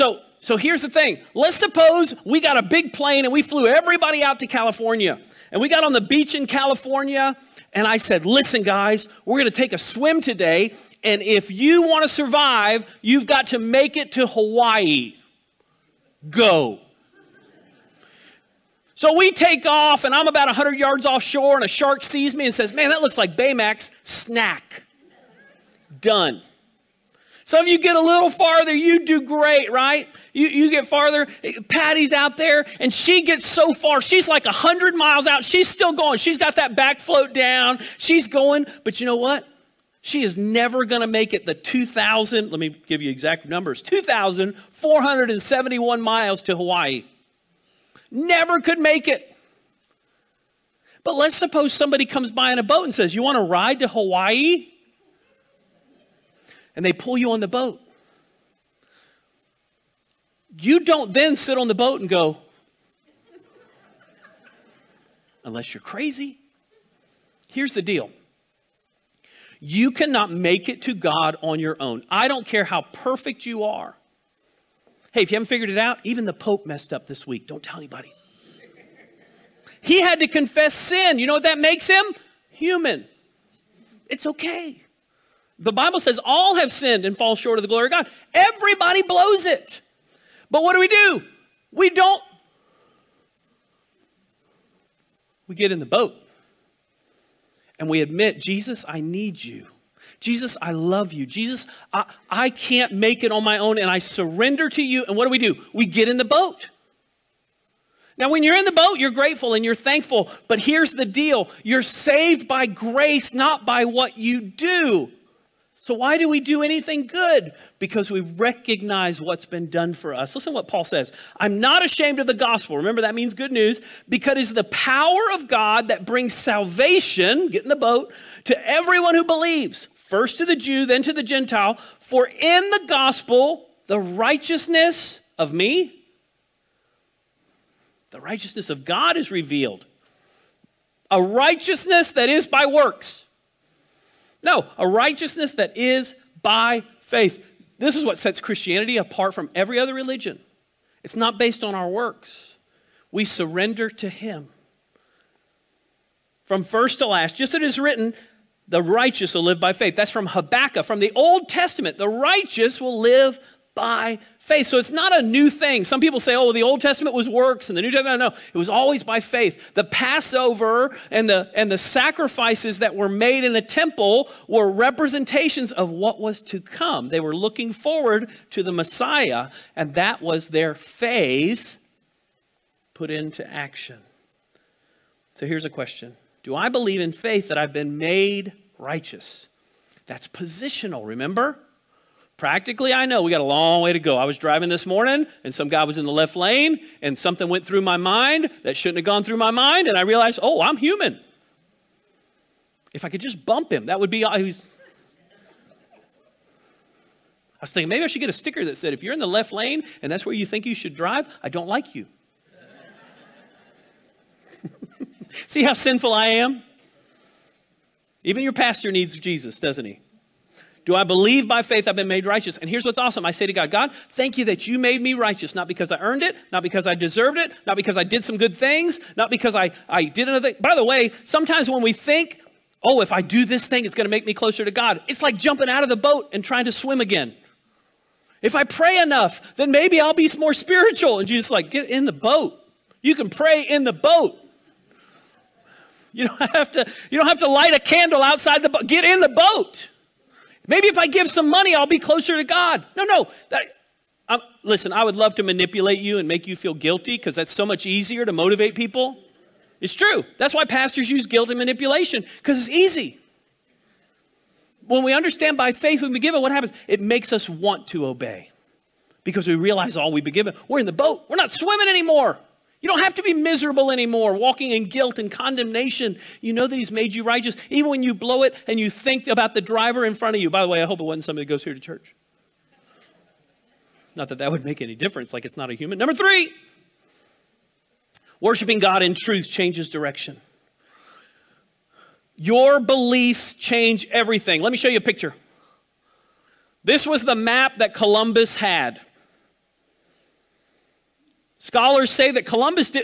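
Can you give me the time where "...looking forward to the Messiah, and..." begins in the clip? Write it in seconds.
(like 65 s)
177 s.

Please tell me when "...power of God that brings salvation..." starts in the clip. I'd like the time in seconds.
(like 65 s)
124 s.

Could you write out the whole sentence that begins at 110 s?
But here's the deal you're saved by grace, not by what you do.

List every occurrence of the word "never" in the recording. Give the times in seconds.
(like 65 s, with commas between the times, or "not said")
40 s, 48 s.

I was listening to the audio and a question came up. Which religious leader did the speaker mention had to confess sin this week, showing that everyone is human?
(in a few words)
the Pope.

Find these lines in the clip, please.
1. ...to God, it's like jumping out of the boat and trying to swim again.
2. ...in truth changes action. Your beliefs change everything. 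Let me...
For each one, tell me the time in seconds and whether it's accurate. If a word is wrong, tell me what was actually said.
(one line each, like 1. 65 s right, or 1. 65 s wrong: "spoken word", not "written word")
1. 234 s right
2. 289 s wrong: "direction", not "action".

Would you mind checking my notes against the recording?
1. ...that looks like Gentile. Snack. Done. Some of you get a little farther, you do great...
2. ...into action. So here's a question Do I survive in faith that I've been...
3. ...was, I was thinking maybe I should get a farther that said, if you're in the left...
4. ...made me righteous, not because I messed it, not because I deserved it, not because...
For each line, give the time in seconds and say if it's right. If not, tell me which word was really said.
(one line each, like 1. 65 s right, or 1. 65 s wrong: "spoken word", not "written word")
1. 22 s wrong: "Baymax", not "Gentile"
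2. 183 s wrong: "believe", not "survive"
3. 204 s wrong: "sticker", not "farther"
4. 224 s wrong: "earned", not "messed".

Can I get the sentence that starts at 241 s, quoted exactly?
And Jesus like, get in the boat.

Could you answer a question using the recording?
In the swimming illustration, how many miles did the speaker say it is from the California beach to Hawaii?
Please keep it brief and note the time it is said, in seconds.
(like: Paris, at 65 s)
2,471 miles, at 43 s.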